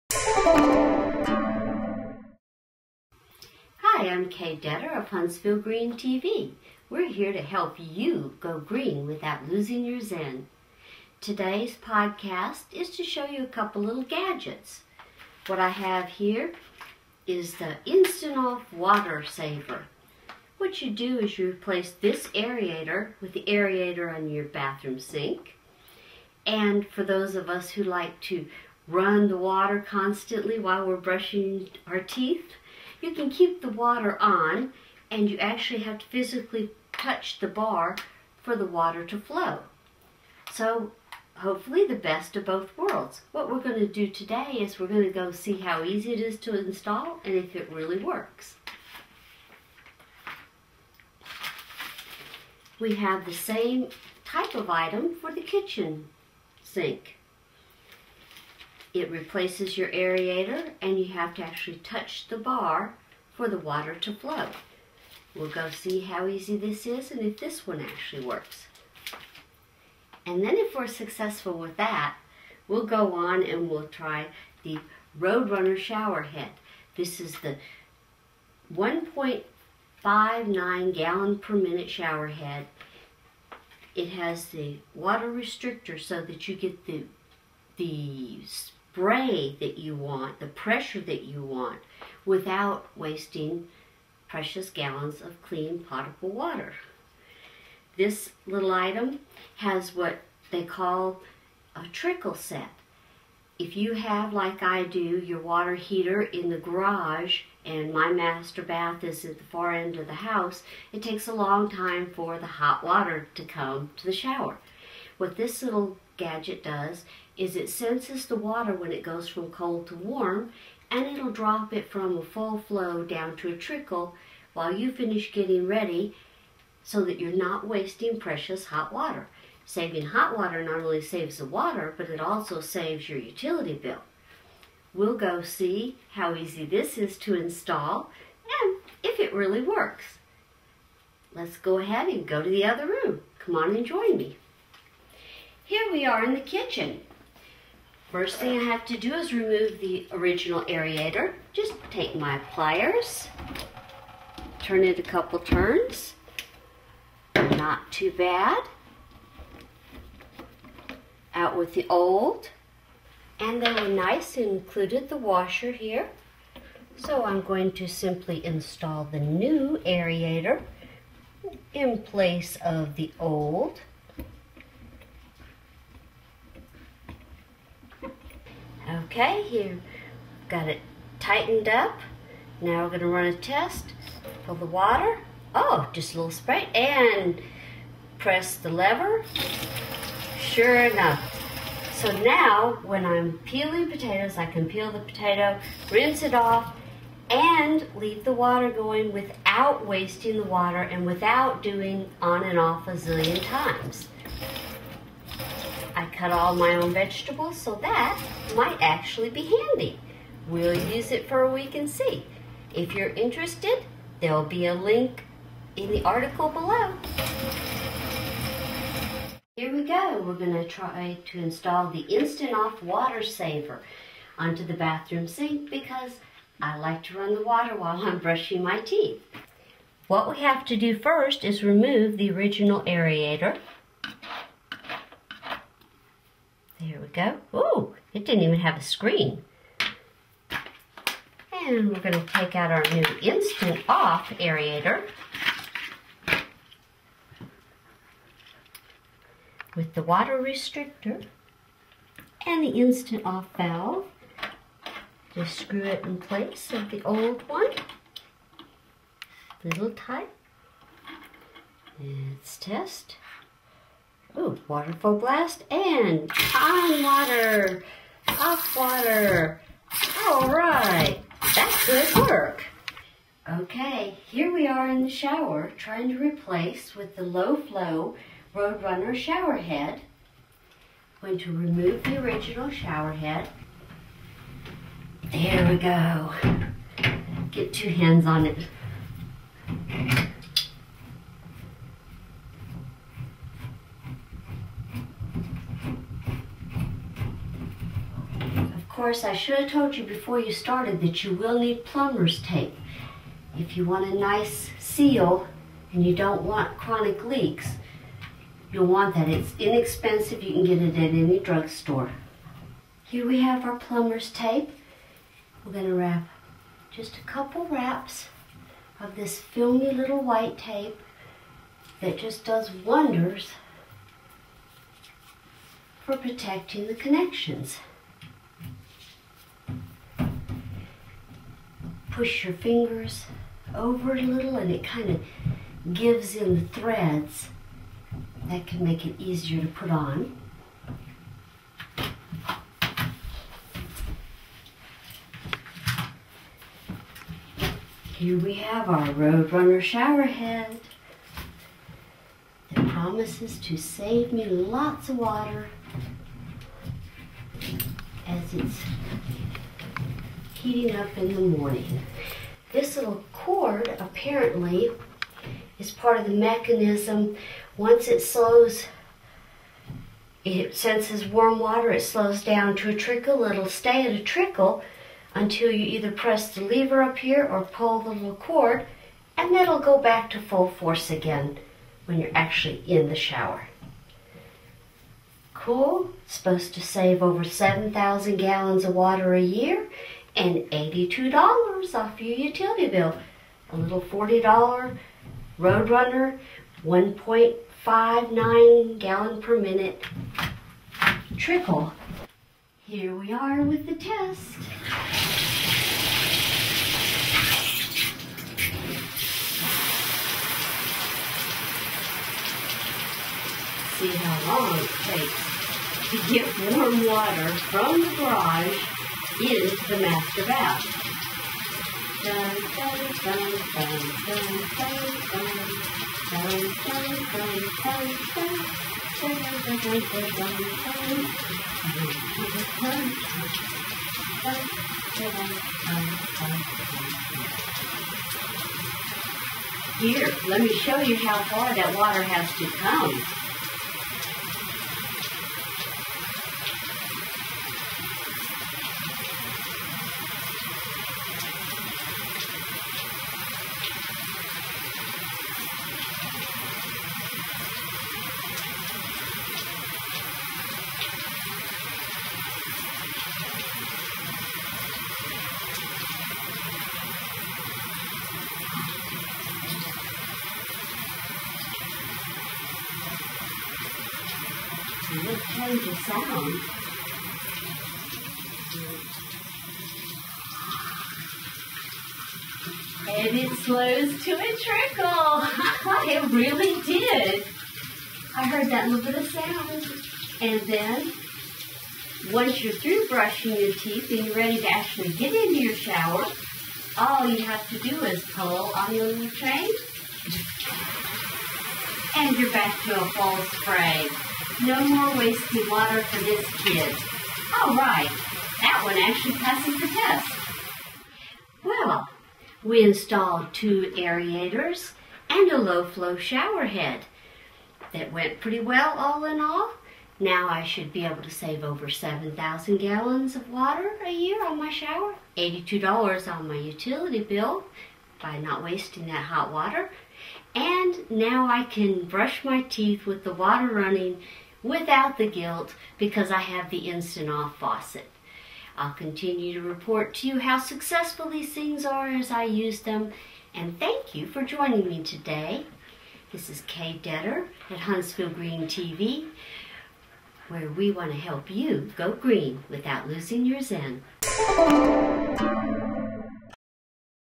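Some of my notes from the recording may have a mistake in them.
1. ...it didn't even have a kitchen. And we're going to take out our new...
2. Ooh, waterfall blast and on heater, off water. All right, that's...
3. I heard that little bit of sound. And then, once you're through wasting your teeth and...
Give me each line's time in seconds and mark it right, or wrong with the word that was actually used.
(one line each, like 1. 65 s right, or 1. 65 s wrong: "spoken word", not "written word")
1. 238 s wrong: "screen", not "kitchen"
2. 264 s wrong: "water", not "heater"
3. 488 s wrong: "brushing", not "wasting".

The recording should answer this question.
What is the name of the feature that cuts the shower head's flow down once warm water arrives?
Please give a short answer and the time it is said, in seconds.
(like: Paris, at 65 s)
trickle set, at 101 s.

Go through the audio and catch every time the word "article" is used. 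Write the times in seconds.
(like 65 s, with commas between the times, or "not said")
216 s.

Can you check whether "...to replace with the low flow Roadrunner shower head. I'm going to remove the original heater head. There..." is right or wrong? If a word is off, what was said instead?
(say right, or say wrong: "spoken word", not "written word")
wrong: "shower", not "heater".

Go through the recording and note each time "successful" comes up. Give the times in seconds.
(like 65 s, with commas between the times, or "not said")
70 s, 540 s.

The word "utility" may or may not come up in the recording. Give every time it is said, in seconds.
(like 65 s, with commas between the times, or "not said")
133 s, 392 s, 526 s.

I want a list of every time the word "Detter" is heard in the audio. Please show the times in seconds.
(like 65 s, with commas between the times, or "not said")
4 s, 547 s.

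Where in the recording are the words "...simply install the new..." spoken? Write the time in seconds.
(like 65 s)
167 s.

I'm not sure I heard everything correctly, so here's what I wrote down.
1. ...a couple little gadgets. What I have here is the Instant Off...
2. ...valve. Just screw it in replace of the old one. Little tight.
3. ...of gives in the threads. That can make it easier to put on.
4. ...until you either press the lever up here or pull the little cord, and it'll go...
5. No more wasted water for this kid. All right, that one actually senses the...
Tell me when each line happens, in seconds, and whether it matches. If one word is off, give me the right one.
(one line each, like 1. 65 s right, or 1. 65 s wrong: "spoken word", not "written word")
1. 13 s right
2. 253 s wrong: "place", not "replace"
3. 335 s right
4. 375 s right
5. 504 s wrong: "passes", not "senses".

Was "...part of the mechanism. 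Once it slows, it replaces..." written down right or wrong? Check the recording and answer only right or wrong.
wrong.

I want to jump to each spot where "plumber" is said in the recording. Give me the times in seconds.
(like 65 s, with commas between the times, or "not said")
301 s, 313 s.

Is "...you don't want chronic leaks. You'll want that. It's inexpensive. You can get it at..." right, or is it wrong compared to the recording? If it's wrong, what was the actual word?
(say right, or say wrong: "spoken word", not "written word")
right.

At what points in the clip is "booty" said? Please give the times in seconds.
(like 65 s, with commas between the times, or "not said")
not said.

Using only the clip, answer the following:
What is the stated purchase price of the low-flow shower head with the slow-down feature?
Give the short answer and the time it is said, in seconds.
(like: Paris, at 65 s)
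$40, at 394 s.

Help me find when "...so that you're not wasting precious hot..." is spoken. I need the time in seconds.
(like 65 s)
126 s.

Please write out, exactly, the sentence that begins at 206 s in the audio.
I cut all my own vegetables, so that might actually be handy.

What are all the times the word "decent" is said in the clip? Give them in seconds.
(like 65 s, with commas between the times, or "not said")
not said.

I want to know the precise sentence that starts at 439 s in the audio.
Here, let me show you how far that water has to come.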